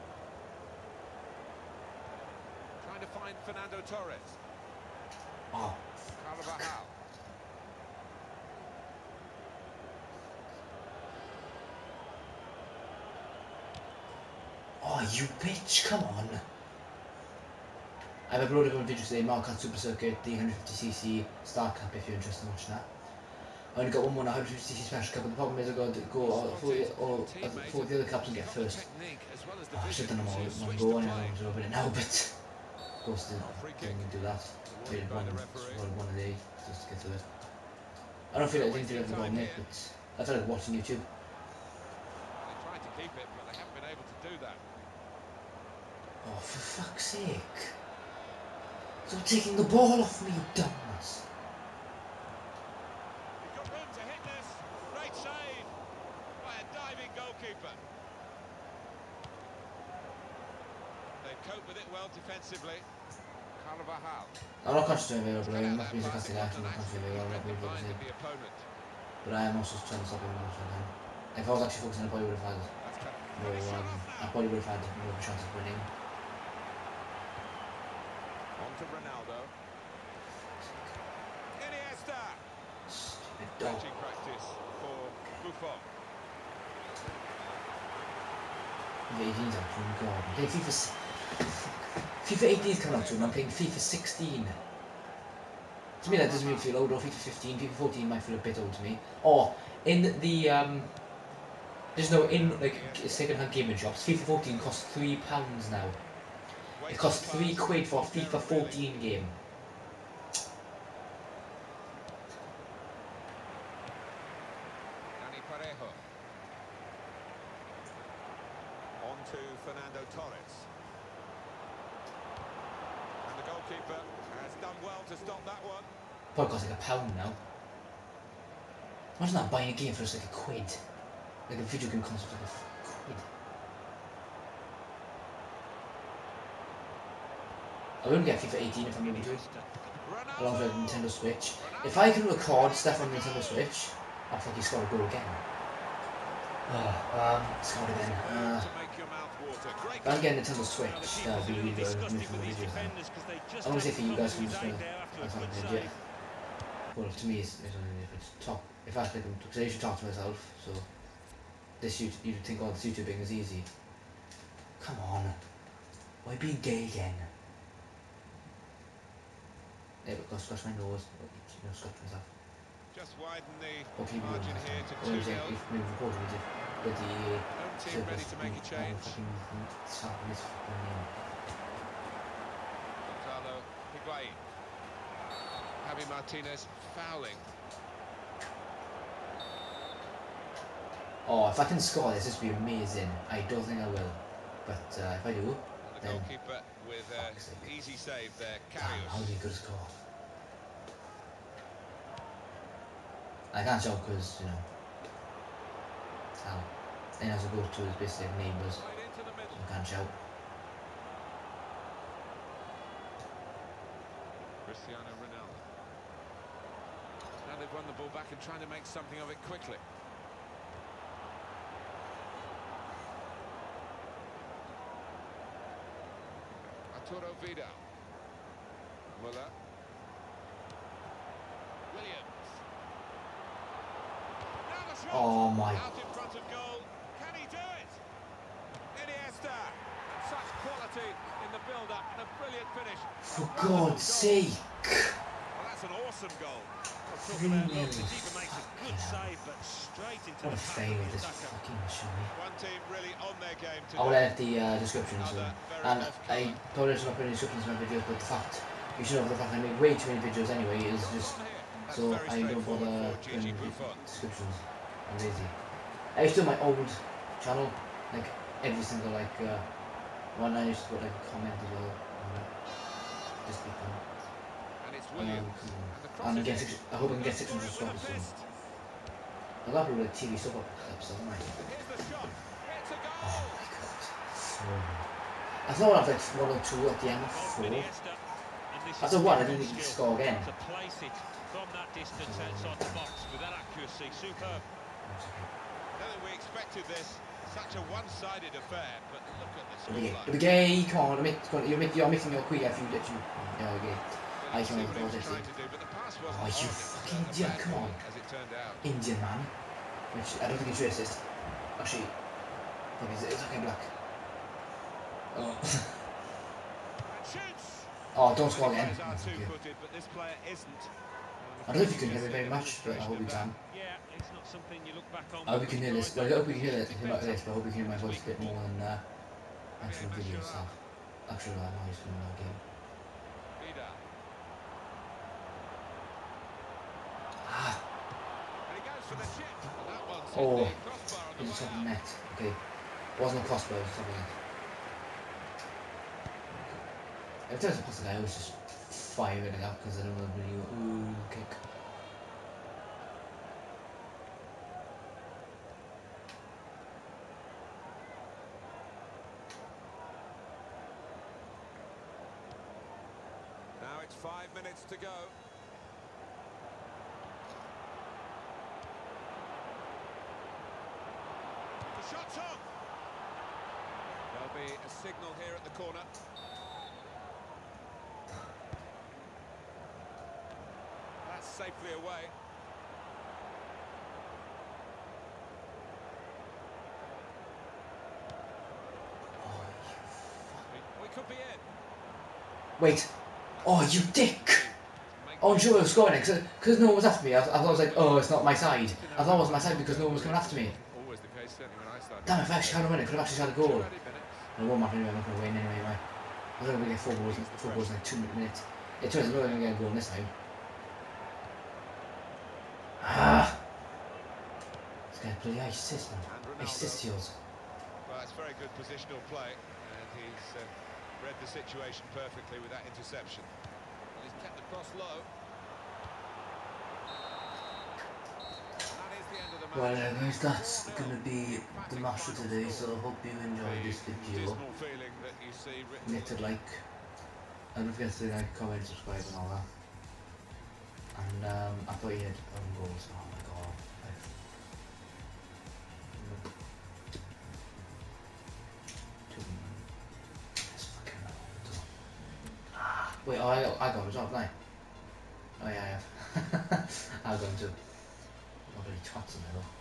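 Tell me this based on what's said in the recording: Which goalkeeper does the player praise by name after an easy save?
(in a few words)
Karius.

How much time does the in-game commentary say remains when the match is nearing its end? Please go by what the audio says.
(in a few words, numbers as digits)
5 minutes.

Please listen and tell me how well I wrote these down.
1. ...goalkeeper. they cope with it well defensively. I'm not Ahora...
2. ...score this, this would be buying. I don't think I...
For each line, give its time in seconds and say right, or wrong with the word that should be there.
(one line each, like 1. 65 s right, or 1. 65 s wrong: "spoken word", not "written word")
1. 57 s right
2. 191 s wrong: "amazing", not "buying".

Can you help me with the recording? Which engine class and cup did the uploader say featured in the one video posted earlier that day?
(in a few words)
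150cc Star Cup.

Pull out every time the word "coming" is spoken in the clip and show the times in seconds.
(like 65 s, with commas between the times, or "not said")
92 s, 400 s.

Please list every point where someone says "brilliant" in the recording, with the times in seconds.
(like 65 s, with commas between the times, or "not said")
242 s.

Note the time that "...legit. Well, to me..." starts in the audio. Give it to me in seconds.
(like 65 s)
155 s.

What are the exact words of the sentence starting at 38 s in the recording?
I don't feel like I didn't do it at the moment, I feel watching YouTube.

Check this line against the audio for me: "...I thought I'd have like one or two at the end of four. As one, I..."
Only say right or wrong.
right.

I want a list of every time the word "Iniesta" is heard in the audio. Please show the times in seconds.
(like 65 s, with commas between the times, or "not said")
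81 s, 239 s.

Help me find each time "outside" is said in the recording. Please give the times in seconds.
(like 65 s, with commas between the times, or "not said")
292 s.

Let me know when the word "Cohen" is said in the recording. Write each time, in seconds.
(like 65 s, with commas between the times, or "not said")
not said.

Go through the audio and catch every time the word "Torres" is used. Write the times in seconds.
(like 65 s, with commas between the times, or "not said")
3 s, 120 s.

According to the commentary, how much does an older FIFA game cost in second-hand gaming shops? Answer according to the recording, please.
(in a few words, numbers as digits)
£3.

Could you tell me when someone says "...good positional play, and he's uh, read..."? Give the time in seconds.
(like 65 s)
418 s.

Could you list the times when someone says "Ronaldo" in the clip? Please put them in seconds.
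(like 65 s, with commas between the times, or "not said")
78 s, 215 s.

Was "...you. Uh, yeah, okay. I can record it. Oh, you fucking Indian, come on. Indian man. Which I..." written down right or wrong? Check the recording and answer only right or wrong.
right.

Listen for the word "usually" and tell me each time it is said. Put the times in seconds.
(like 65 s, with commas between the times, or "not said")
159 s.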